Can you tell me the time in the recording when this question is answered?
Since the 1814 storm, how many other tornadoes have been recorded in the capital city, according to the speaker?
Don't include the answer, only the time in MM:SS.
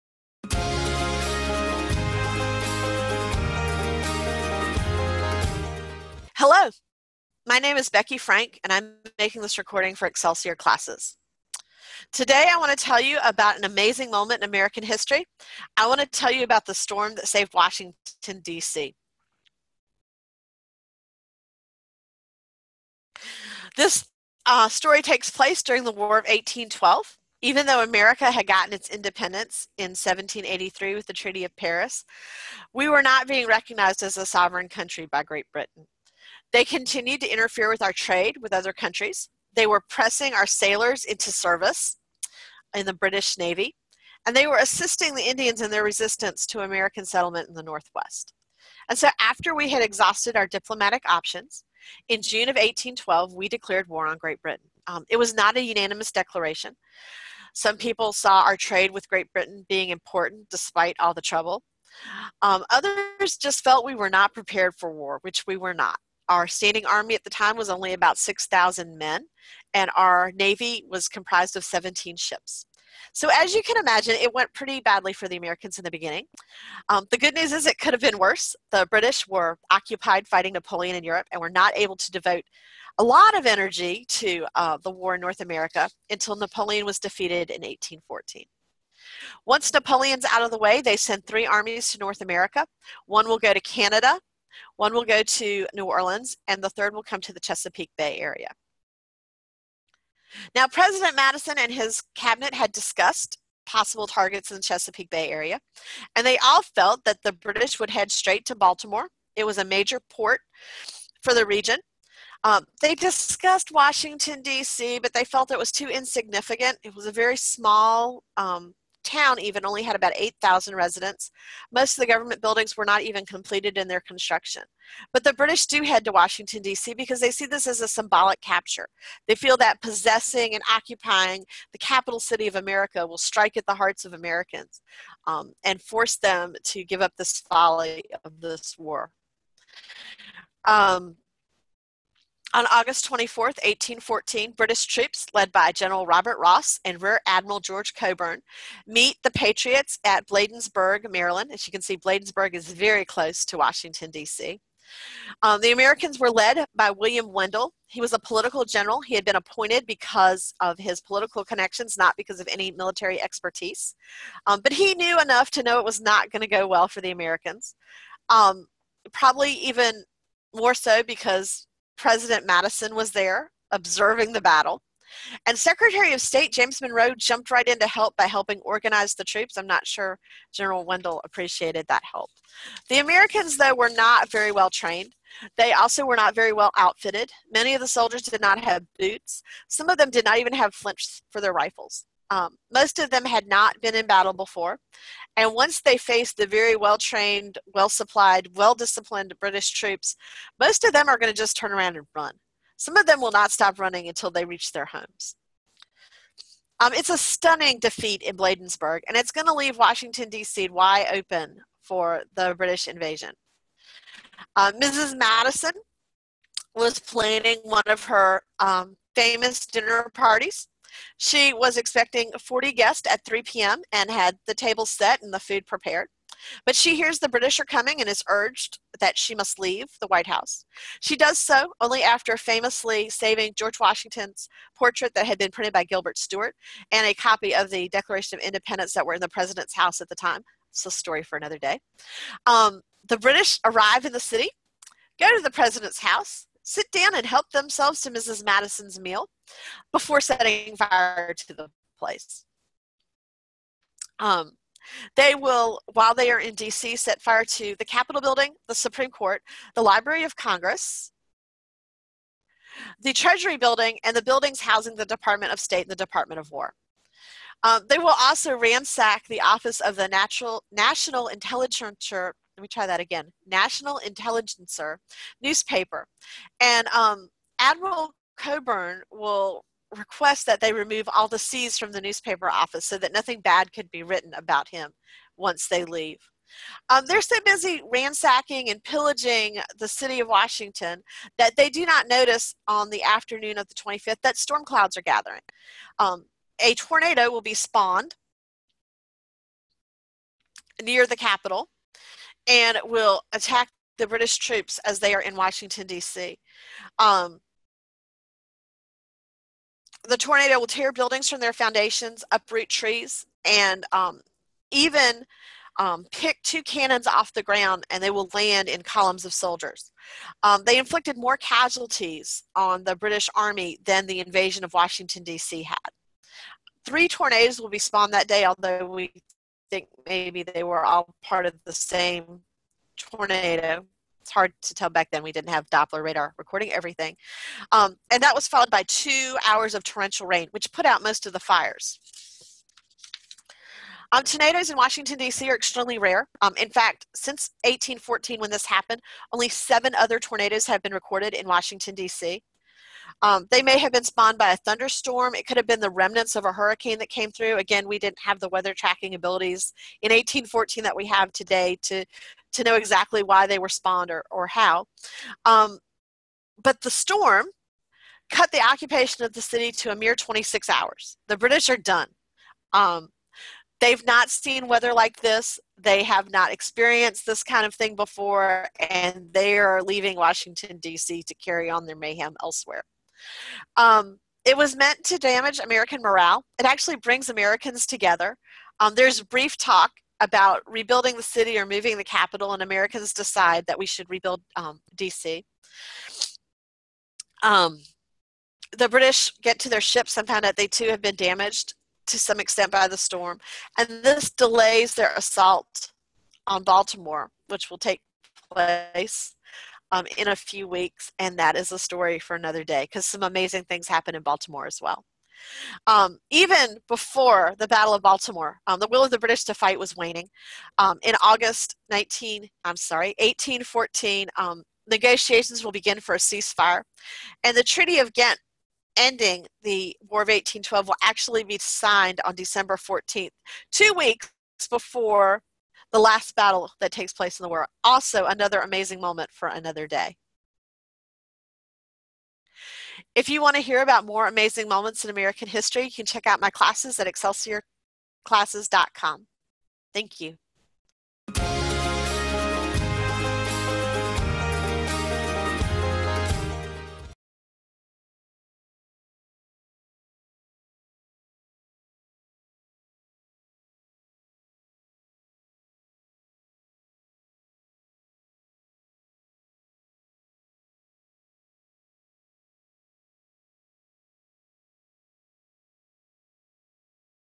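05:49.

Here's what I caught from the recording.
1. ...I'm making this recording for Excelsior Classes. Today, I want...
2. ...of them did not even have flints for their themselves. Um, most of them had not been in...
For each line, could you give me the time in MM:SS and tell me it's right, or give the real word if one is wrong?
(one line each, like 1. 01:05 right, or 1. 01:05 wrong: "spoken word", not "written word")
1. 00:08 right
2. 03:09 wrong: "rifles", not "themselves".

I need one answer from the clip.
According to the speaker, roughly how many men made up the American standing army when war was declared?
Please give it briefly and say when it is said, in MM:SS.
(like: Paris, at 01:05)
6,000, at 01:08.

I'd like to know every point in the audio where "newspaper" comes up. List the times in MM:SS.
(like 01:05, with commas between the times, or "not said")
04:35, 04:42.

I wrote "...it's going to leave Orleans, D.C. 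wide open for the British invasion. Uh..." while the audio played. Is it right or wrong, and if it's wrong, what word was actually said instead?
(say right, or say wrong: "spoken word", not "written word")
wrong: "Washington", not "Orleans".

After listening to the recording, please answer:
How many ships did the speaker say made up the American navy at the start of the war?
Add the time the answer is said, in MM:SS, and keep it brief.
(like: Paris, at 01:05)
17, at 01:11.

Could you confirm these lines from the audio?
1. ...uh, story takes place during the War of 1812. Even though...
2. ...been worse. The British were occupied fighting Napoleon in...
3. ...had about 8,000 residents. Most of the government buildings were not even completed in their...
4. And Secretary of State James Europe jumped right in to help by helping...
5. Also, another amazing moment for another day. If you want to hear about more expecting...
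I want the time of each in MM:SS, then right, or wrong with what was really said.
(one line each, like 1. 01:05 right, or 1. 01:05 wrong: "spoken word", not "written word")
1. 00:24 right
2. 01:18 right
3. 01:59 right
4. 02:55 wrong: "Monroe", not "Europe"
5. 07:17 wrong: "amazing", not "expecting".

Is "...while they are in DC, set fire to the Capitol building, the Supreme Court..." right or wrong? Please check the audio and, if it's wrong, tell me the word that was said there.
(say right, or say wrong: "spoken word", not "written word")
right.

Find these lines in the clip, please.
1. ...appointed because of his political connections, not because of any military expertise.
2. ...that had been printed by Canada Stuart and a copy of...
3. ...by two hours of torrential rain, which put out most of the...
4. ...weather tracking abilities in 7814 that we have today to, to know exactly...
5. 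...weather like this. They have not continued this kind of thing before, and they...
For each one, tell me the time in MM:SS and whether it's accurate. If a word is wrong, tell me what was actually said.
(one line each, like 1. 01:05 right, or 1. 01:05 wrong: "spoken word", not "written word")
1. 02:39 right
2. 03:55 wrong: "Gilbert", not "Canada"
3. 05:38 right
4. 05:58 wrong: "1814", not "7814"
5. 06:14 wrong: "experienced", not "continued".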